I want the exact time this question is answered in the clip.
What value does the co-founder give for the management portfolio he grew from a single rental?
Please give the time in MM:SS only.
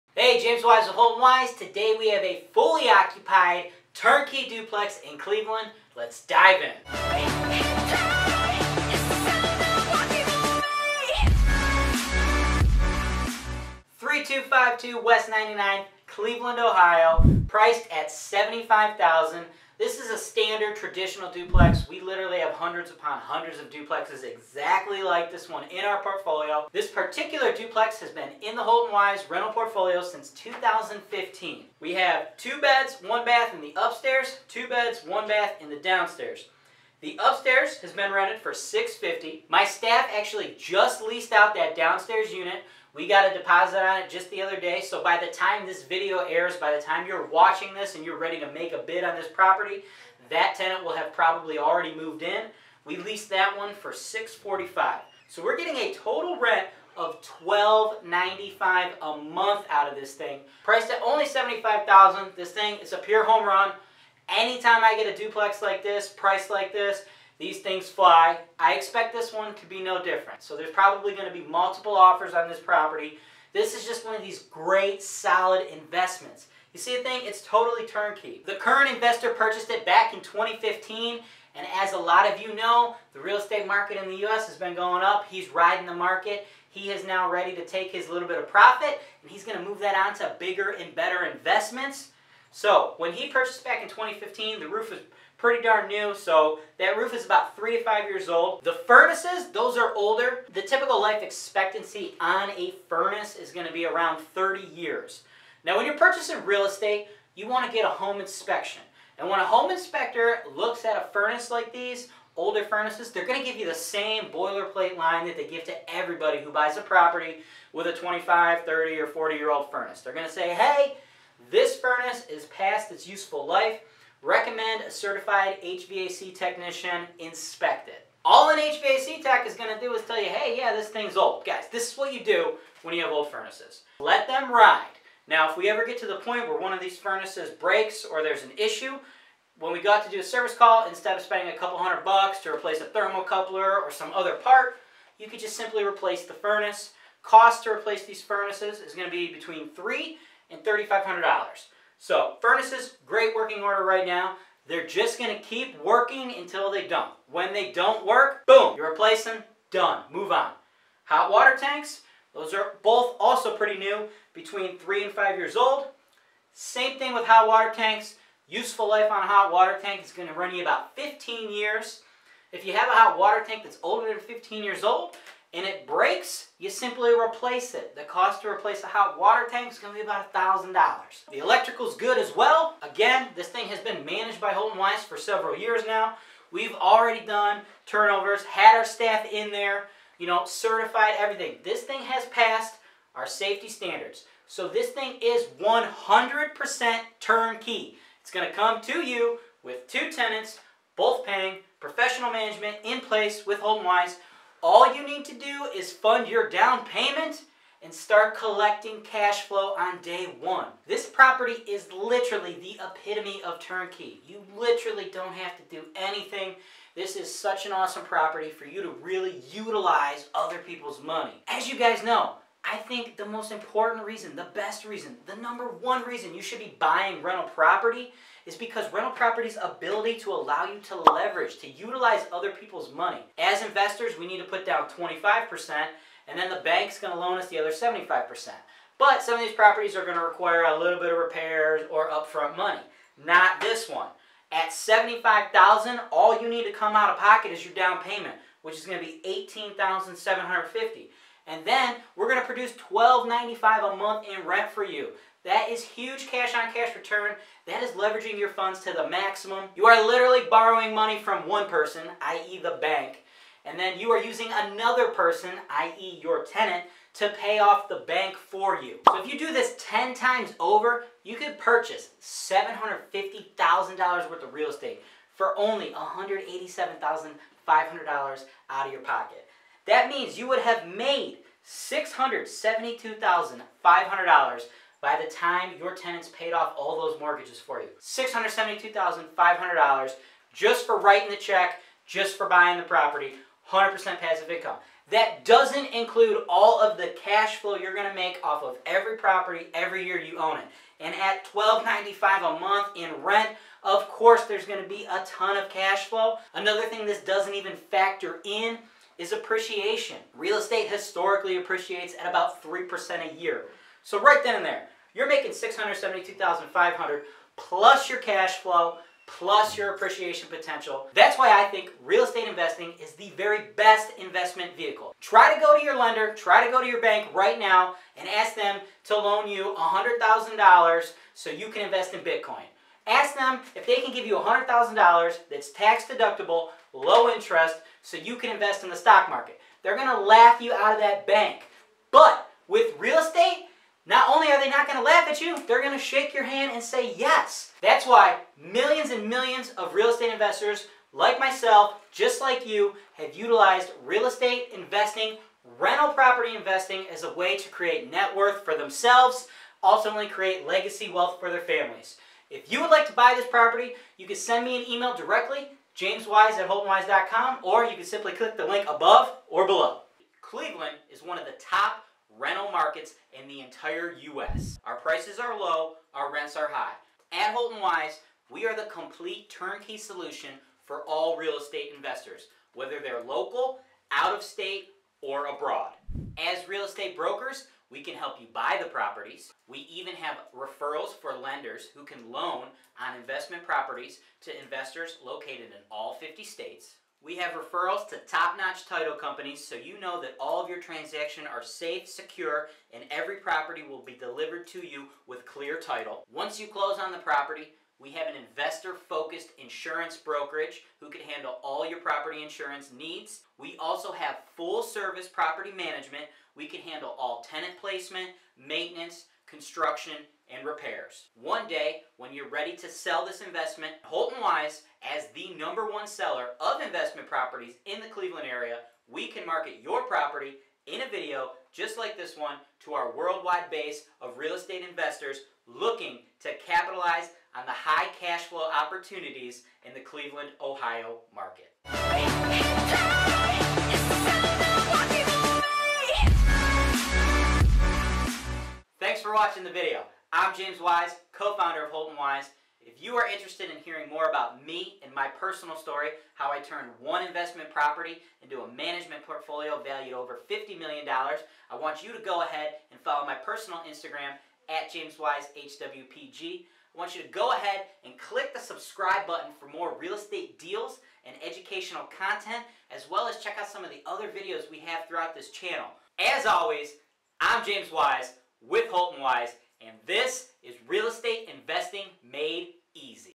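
07:40.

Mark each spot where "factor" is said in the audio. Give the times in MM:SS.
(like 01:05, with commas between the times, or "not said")
05:07.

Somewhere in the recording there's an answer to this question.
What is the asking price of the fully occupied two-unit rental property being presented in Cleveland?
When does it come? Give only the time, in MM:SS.
00:18.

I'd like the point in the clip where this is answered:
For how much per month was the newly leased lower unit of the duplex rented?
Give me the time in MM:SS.
00:53.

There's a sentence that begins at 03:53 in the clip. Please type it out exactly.
As investors, we need to put down 25% and then the bank's gonna loan us the other 75%.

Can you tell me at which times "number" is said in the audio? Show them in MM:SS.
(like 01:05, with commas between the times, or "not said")
03:45, 07:05.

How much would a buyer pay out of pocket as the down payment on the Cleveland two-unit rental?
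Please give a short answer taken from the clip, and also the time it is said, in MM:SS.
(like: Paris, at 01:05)
$18,750, at 04:09.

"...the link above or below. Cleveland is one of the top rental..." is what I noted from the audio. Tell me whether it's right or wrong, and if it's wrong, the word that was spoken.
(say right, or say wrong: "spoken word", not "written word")
right.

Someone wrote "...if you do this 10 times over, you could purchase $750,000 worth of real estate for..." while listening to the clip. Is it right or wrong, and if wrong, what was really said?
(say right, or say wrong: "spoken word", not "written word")
right.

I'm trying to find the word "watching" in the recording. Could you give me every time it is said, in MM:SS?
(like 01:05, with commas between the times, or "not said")
00:47, 07:29.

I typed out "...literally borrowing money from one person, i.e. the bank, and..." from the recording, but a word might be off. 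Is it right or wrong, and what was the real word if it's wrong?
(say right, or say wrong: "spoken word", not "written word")
right.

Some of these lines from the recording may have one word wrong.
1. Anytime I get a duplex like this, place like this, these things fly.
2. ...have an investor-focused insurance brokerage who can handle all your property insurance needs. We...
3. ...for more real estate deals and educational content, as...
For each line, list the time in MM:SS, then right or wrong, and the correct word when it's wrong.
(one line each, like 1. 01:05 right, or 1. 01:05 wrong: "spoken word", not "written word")
1. 01:04 wrong: "price", not "place"
2. 06:48 right
3. 07:49 right.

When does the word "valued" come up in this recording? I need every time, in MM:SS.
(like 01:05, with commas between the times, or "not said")
07:39.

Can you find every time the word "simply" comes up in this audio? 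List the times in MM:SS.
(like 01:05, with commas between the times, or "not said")
02:25, 02:56, 06:08.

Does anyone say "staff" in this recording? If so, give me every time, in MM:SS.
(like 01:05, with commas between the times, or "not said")
00:39, 03:08.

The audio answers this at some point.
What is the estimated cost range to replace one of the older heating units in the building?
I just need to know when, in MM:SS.
02:29.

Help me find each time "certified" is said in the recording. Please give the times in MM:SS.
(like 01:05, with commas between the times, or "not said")
02:04, 03:10.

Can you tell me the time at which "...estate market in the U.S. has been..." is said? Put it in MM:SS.
01:23.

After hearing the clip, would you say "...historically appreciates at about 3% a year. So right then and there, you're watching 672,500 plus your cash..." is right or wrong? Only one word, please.
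wrong.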